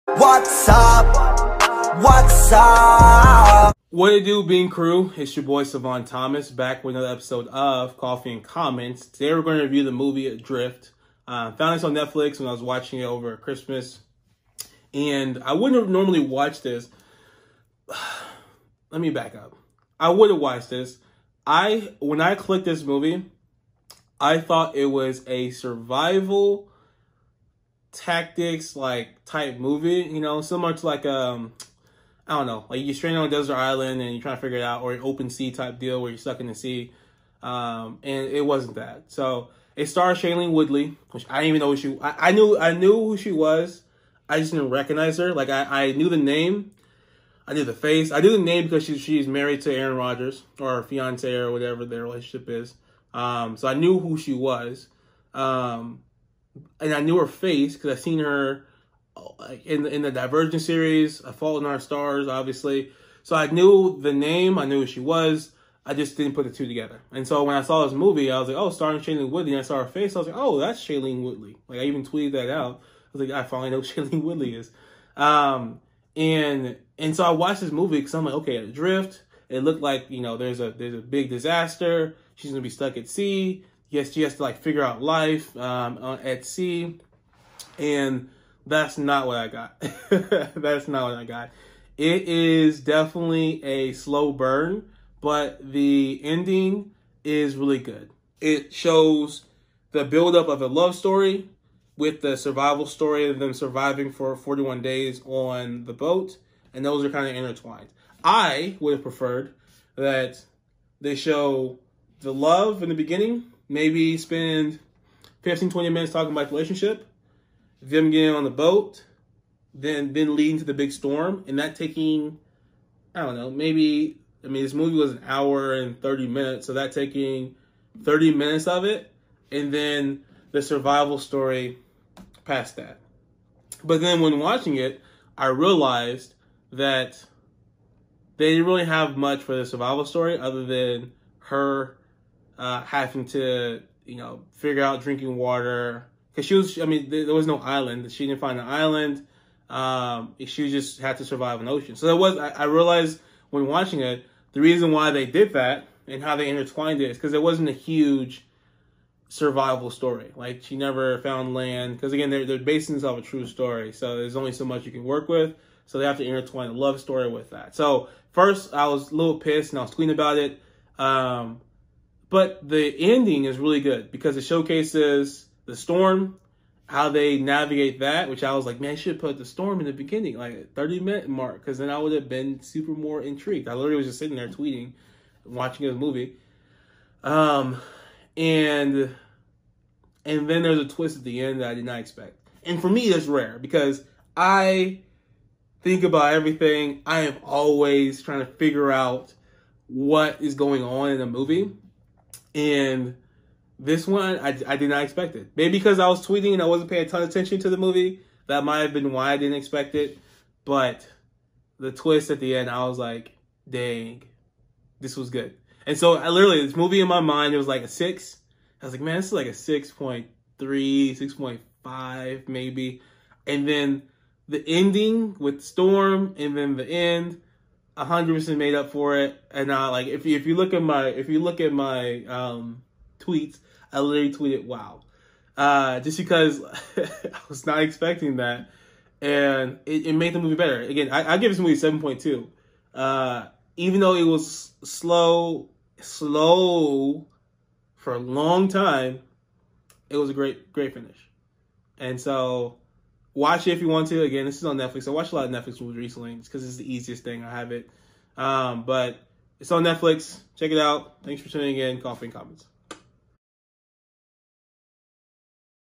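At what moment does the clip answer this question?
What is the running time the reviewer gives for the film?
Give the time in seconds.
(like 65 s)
125 s.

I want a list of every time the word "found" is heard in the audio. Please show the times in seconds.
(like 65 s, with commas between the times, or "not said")
11 s, 161 s.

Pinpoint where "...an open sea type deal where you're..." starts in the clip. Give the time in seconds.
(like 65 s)
34 s.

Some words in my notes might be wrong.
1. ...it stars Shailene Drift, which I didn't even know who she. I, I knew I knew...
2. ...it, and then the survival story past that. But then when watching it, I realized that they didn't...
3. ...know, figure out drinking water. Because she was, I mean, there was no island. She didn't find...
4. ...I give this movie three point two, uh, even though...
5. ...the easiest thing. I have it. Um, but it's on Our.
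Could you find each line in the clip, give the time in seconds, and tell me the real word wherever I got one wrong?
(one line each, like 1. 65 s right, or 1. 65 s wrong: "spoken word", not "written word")
1. 39 s wrong: "Woodley", not "Drift"
2. 128 s right
3. 144 s right
4. 241 s wrong: "seven", not "three"
5. 256 s wrong: "Netflix", not "Our".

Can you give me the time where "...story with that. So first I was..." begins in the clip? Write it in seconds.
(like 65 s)
166 s.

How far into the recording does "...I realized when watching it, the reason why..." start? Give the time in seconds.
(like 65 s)
152 s.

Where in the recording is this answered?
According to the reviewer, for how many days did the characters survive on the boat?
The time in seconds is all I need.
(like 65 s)
104 s.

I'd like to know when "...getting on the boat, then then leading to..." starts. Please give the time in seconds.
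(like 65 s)
118 s.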